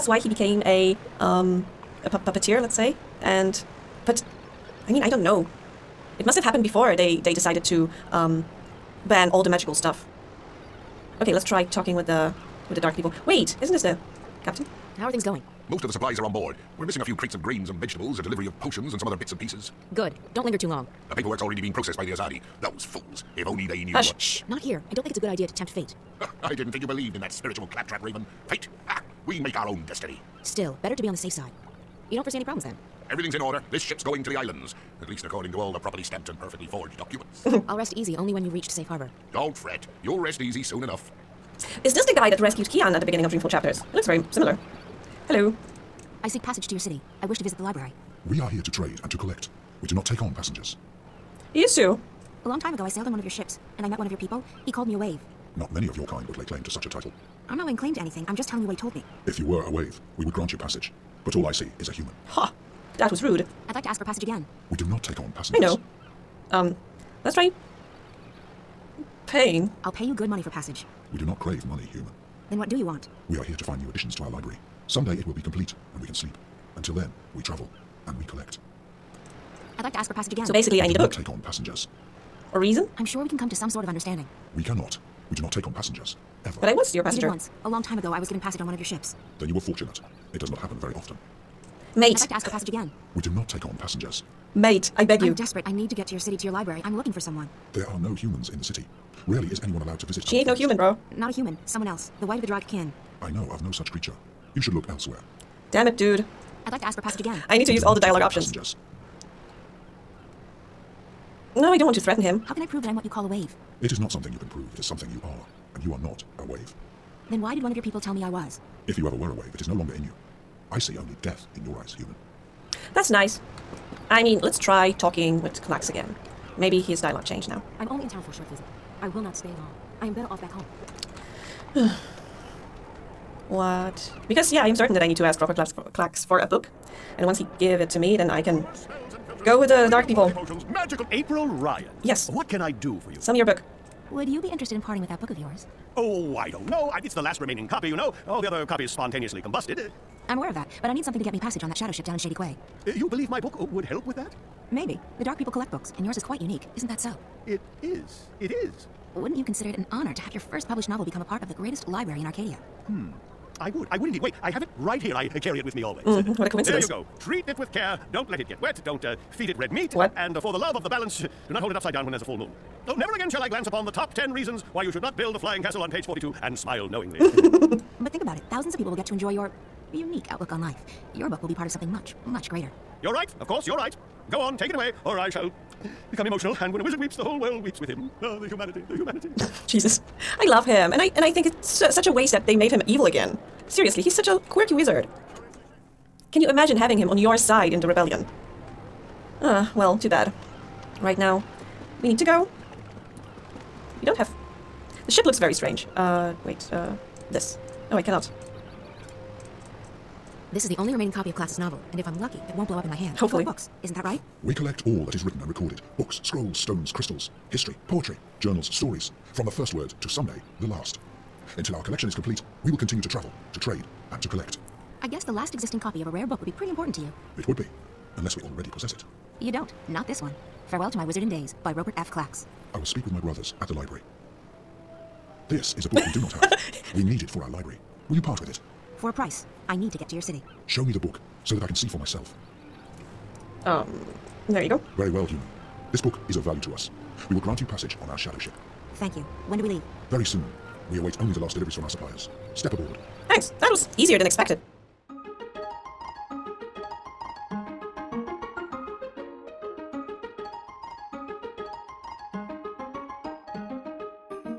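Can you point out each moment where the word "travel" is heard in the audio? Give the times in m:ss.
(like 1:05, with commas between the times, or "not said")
1:17, 3:43.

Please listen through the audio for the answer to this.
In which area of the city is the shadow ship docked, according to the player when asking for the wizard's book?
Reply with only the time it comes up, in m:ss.
2:32.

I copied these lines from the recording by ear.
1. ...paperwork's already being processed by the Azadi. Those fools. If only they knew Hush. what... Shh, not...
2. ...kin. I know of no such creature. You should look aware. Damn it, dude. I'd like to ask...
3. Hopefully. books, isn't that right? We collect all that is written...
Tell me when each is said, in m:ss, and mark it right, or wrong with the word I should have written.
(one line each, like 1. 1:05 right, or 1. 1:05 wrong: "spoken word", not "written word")
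1. 0:21 right
2. 1:42 wrong: "elsewhere", not "aware"
3. 3:33 right.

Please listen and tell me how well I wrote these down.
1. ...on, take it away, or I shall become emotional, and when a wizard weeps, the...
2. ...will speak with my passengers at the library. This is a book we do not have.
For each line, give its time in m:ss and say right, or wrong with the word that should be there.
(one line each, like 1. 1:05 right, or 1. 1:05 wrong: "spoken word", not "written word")
1. 3:04 right
2. 3:52 wrong: "brothers", not "passengers".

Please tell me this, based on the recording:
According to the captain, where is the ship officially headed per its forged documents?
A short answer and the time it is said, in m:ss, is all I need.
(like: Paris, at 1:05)
The islands, at 0:34.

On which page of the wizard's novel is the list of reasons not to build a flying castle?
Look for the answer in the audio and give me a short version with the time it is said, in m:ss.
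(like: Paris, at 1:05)
42, at 2:55.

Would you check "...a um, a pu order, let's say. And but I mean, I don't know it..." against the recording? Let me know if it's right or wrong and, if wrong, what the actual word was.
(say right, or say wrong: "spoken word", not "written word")
wrong: "puppeteer", not "order".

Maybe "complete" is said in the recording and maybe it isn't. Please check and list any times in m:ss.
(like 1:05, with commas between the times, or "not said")
1:15, 3:42.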